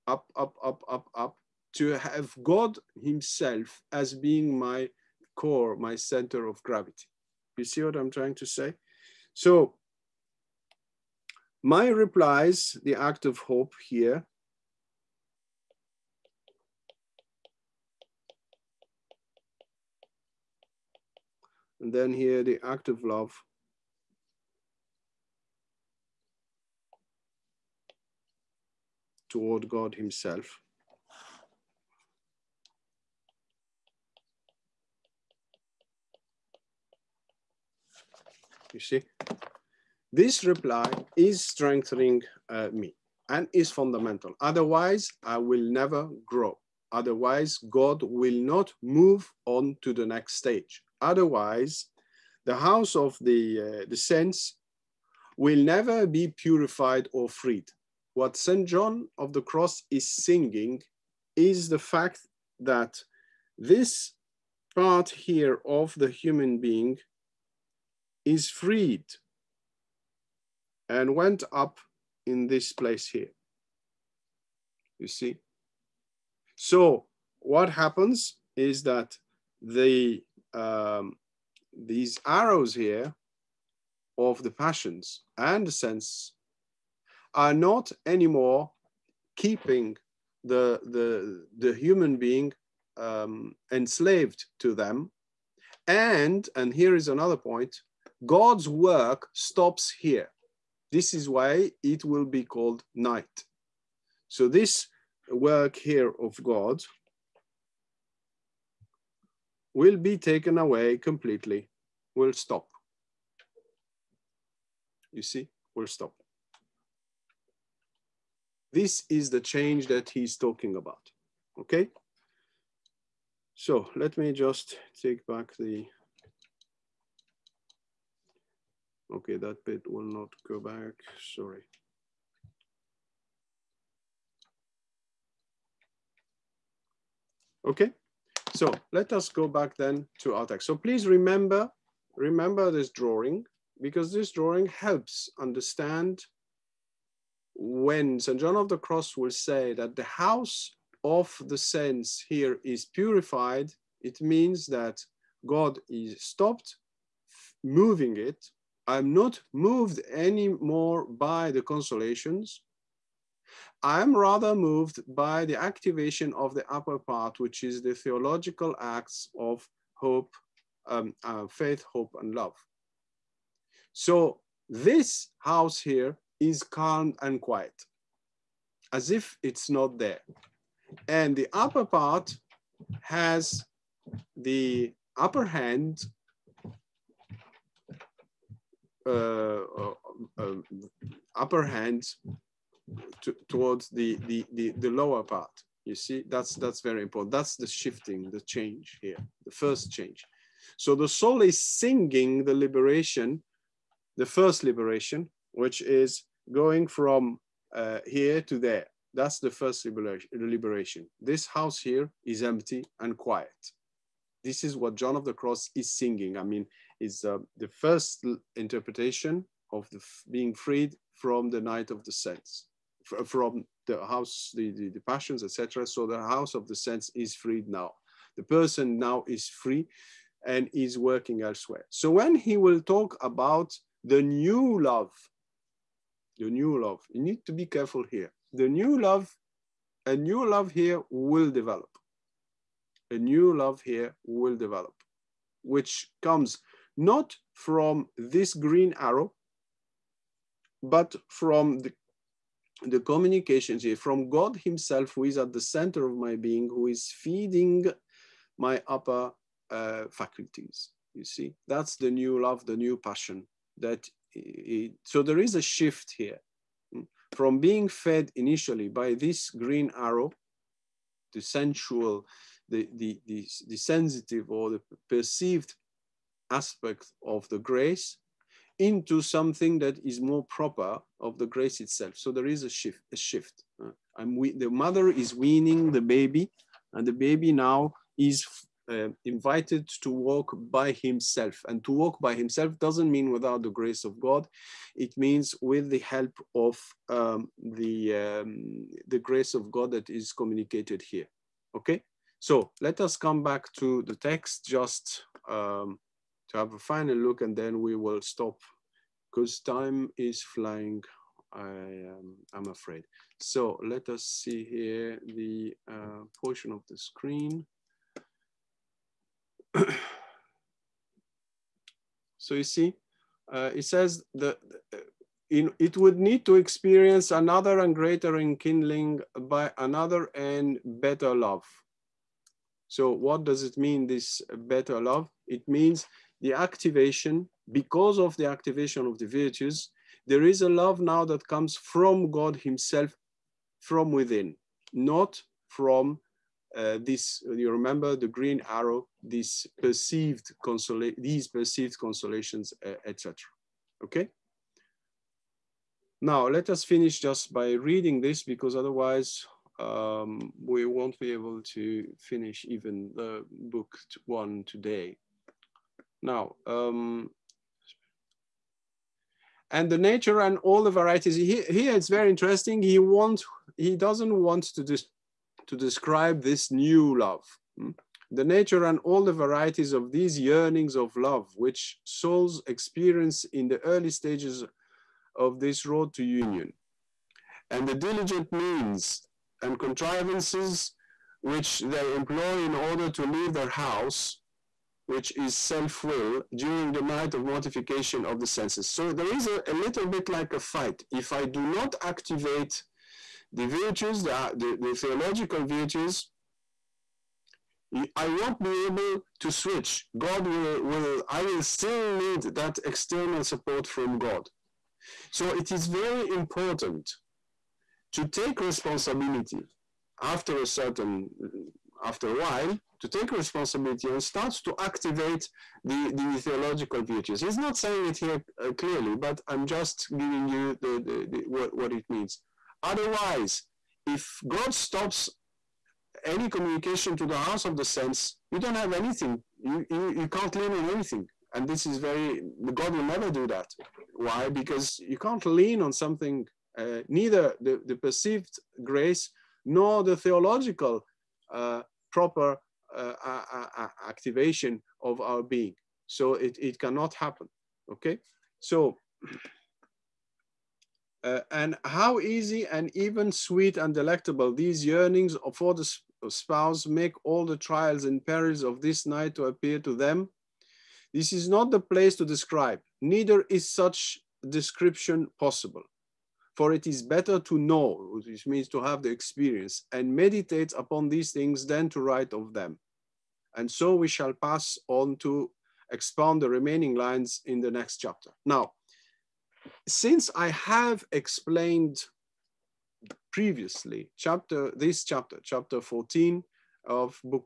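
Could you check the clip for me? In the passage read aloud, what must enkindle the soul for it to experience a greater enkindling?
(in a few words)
Another and better love.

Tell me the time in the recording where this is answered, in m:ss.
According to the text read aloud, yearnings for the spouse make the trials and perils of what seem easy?
7:48.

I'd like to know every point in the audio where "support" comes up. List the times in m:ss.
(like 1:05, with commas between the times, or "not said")
6:53.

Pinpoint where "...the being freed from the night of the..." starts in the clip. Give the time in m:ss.
3:39.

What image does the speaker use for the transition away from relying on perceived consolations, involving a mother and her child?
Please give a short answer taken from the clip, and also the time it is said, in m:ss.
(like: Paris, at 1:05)
Weaning the baby, at 4:45.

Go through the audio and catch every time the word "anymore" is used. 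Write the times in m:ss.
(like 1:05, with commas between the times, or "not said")
1:28, 2:40.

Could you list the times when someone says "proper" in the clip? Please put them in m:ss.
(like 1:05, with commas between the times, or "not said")
4:40, 7:32.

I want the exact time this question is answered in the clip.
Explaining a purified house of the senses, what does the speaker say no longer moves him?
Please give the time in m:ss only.
2:41.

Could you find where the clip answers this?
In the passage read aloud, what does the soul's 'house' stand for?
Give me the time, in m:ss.
6:35.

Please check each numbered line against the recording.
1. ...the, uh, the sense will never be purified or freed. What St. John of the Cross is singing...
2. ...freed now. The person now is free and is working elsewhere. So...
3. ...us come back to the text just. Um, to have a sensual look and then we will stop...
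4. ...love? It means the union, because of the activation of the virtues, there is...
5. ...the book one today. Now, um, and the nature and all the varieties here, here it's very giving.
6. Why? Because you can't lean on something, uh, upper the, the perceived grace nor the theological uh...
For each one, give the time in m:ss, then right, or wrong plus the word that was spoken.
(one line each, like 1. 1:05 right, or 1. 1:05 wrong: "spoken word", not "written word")
1. 0:53 right
2. 3:47 right
3. 5:03 wrong: "final", not "sensual"
4. 5:35 wrong: "activation", not "union"
5. 6:03 wrong: "interesting", not "giving"
6. 7:24 wrong: "neither", not "upper".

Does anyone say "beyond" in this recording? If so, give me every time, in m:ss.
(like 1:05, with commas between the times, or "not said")
not said.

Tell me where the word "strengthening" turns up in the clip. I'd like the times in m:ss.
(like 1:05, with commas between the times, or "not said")
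0:41.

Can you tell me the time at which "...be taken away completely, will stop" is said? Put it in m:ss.
1:49.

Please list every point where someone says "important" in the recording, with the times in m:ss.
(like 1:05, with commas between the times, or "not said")
3:17, 6:56.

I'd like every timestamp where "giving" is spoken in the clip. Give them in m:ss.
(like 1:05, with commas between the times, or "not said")
7:10.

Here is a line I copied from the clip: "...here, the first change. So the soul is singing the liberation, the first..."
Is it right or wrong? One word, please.
right.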